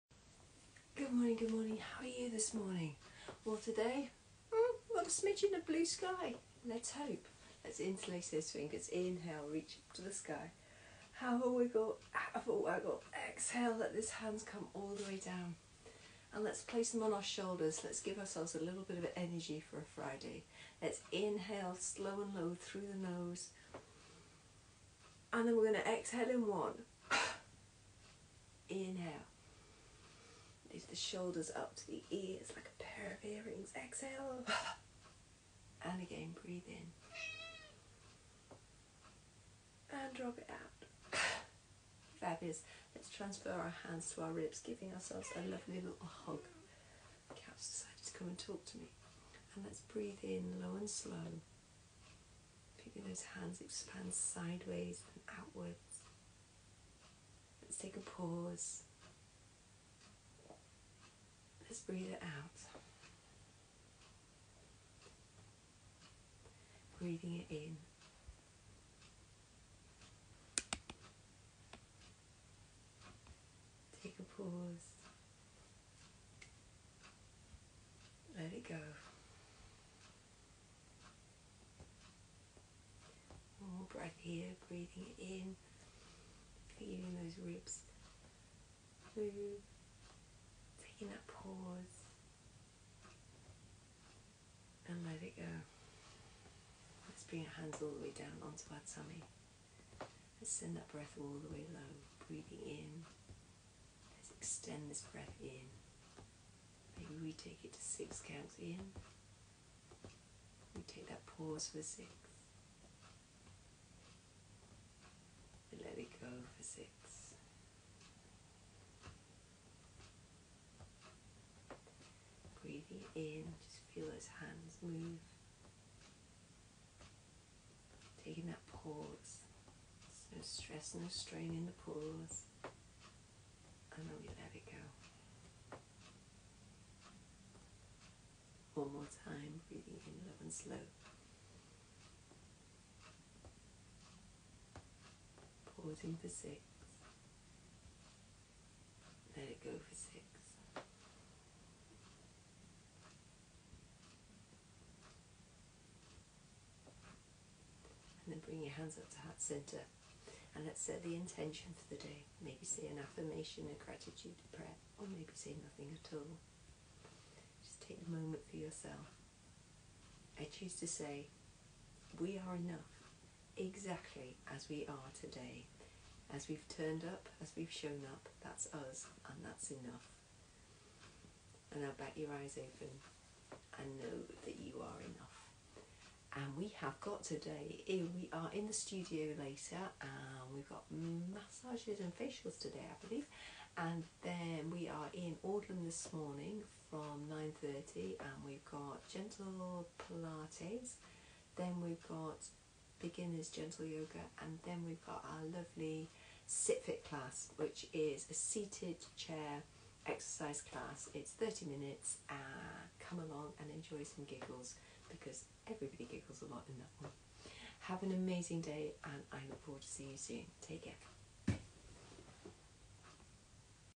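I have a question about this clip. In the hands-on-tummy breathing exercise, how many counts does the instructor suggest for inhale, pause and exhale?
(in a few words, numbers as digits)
6.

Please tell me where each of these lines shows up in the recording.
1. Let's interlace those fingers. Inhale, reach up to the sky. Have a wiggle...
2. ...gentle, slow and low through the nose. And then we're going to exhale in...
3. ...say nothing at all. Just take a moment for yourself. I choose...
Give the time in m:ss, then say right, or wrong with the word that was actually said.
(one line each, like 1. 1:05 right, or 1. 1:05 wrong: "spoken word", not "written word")
1. 0:07 right
2. 0:21 wrong: "inhale", not "gentle"
3. 2:45 right.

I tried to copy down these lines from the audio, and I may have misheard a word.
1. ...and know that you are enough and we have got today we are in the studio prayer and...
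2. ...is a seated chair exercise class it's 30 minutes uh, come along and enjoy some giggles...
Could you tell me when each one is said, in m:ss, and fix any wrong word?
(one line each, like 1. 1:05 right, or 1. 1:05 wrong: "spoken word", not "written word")
1. 3:03 wrong: "later", not "prayer"
2. 3:27 right.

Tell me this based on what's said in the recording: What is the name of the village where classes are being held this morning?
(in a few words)
Audlem.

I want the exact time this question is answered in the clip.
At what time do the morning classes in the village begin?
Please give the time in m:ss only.
3:17.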